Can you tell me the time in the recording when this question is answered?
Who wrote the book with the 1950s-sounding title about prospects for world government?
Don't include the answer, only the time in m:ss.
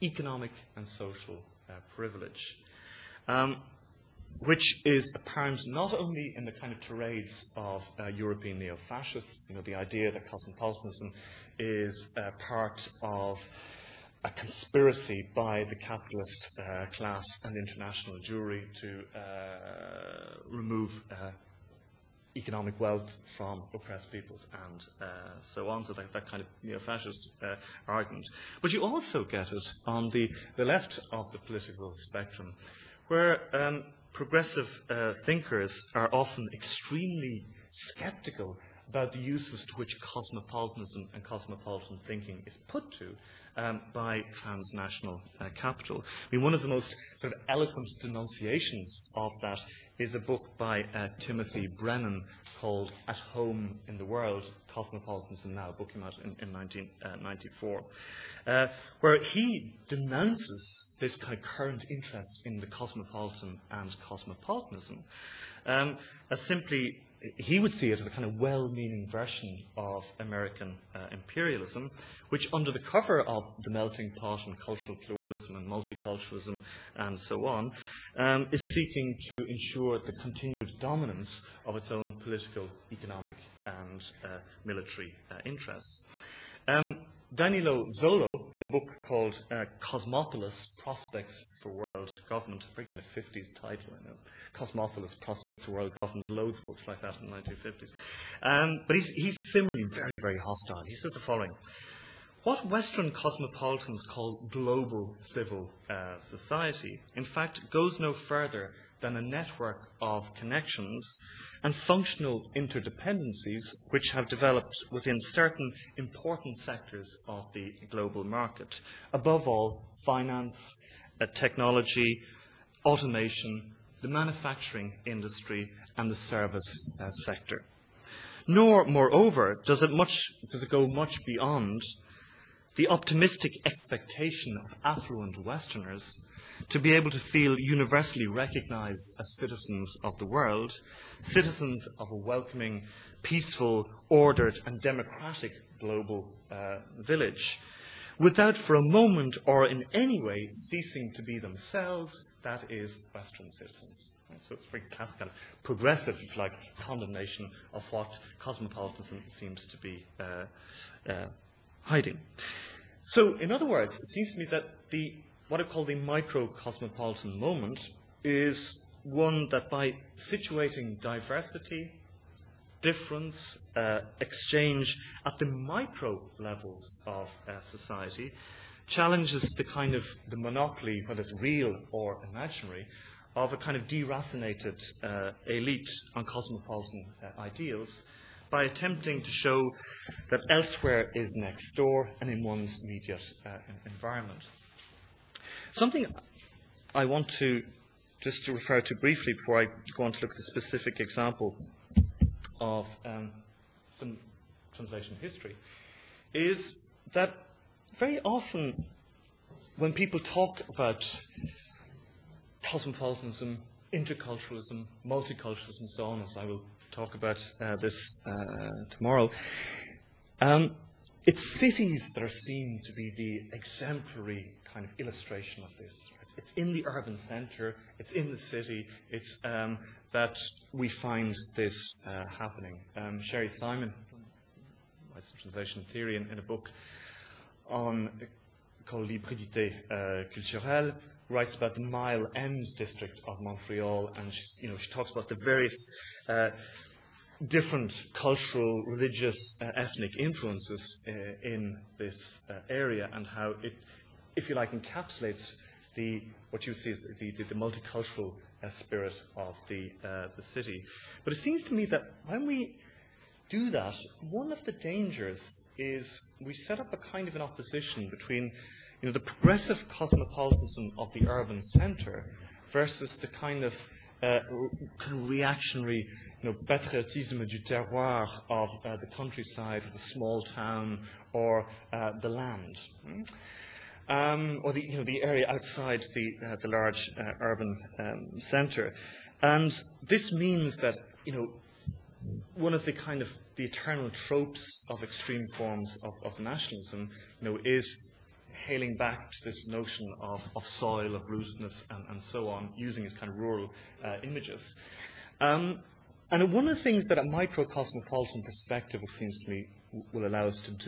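1:27.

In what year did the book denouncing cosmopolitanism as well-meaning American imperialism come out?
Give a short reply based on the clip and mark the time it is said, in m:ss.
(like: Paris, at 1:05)
1994, at 0:56.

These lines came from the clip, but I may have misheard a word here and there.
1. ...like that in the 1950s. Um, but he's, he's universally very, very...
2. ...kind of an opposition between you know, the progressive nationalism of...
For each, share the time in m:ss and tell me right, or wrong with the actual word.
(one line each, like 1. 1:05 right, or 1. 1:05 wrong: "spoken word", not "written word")
1. 1:36 wrong: "similarly", not "universally"
2. 4:26 wrong: "cosmopolitanism", not "nationalism".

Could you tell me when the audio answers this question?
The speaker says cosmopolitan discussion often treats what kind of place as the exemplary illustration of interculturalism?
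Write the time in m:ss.
3:41.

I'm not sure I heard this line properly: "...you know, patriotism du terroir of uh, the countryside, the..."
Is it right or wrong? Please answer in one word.
right.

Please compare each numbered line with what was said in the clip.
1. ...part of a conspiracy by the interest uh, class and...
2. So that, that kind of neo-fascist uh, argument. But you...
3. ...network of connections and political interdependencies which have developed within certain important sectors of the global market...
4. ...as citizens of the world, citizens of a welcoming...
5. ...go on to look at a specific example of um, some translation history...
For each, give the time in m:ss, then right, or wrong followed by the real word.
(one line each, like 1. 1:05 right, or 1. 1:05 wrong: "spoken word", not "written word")
1. 0:12 wrong: "capitalist", not "interest"
2. 0:25 right
3. 1:49 wrong: "functional", not "political"
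4. 2:19 right
5. 3:19 right.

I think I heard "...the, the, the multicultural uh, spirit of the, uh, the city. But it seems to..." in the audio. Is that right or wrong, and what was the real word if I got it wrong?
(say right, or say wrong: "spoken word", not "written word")
right.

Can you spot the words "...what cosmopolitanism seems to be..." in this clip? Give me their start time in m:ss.
2:37.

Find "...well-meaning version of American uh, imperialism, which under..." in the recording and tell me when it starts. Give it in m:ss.
1:08.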